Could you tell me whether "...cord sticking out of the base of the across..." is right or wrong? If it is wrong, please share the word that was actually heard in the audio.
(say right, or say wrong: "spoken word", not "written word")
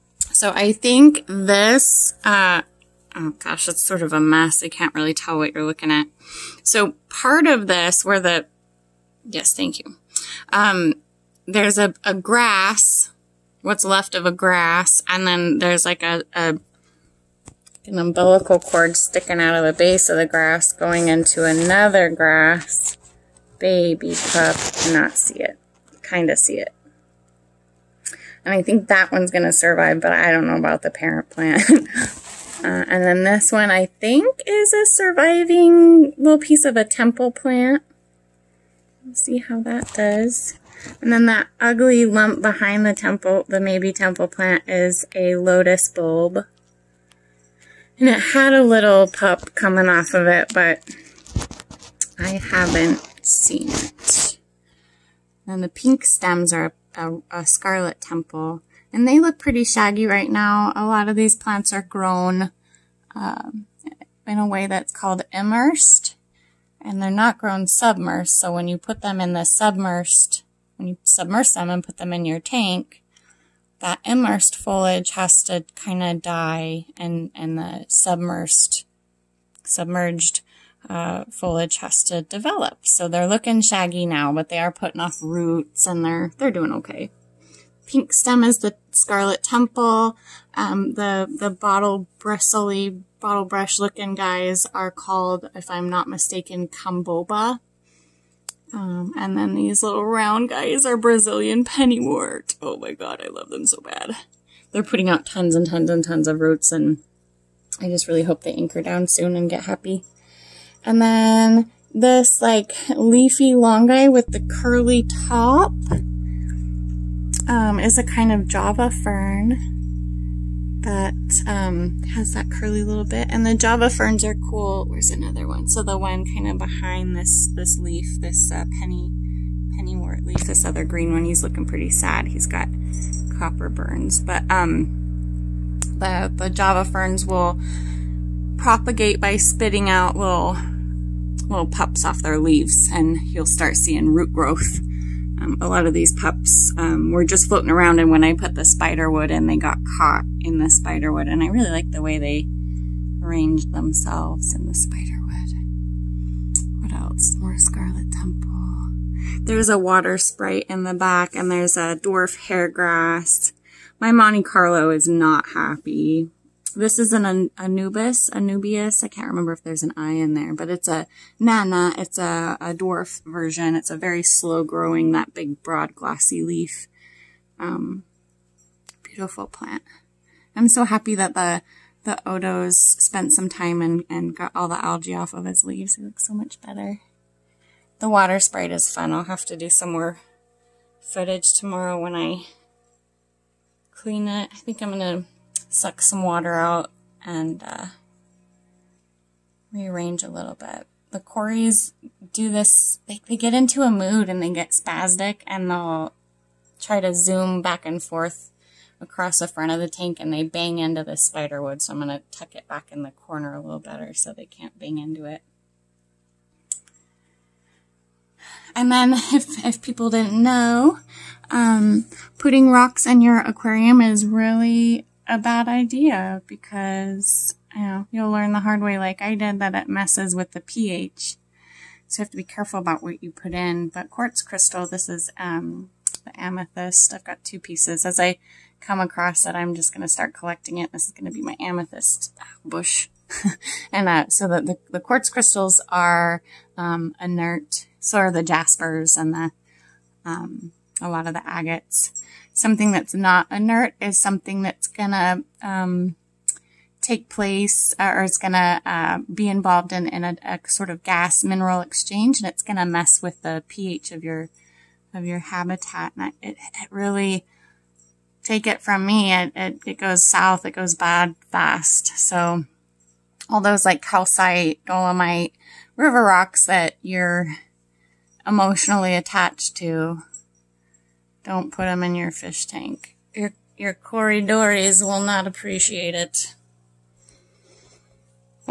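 wrong: "grass", not "across".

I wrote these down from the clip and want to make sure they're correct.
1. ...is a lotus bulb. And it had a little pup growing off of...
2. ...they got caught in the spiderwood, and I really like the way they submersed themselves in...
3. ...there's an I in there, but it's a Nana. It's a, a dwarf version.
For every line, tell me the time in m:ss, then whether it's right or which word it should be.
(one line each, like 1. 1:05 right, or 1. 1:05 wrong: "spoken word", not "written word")
1. 0:44 wrong: "coming", not "growing"
2. 2:29 wrong: "arranged", not "submersed"
3. 2:49 right.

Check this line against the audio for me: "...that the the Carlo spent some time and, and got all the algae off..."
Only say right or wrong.
wrong.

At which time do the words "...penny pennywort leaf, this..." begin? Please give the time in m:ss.
2:08.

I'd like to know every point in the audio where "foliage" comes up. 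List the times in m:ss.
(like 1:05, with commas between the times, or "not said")
1:14, 1:21.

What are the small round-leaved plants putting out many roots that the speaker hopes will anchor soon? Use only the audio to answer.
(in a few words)
Brazilian pennywort.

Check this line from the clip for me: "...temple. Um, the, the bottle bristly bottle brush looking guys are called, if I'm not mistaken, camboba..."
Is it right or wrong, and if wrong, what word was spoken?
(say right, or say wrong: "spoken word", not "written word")
right.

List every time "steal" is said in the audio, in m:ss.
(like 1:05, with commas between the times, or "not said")
not said.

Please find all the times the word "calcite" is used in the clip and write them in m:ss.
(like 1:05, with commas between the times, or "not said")
4:34.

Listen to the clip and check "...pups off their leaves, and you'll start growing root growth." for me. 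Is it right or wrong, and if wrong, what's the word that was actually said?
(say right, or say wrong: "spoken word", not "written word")
wrong: "seeing", not "growing".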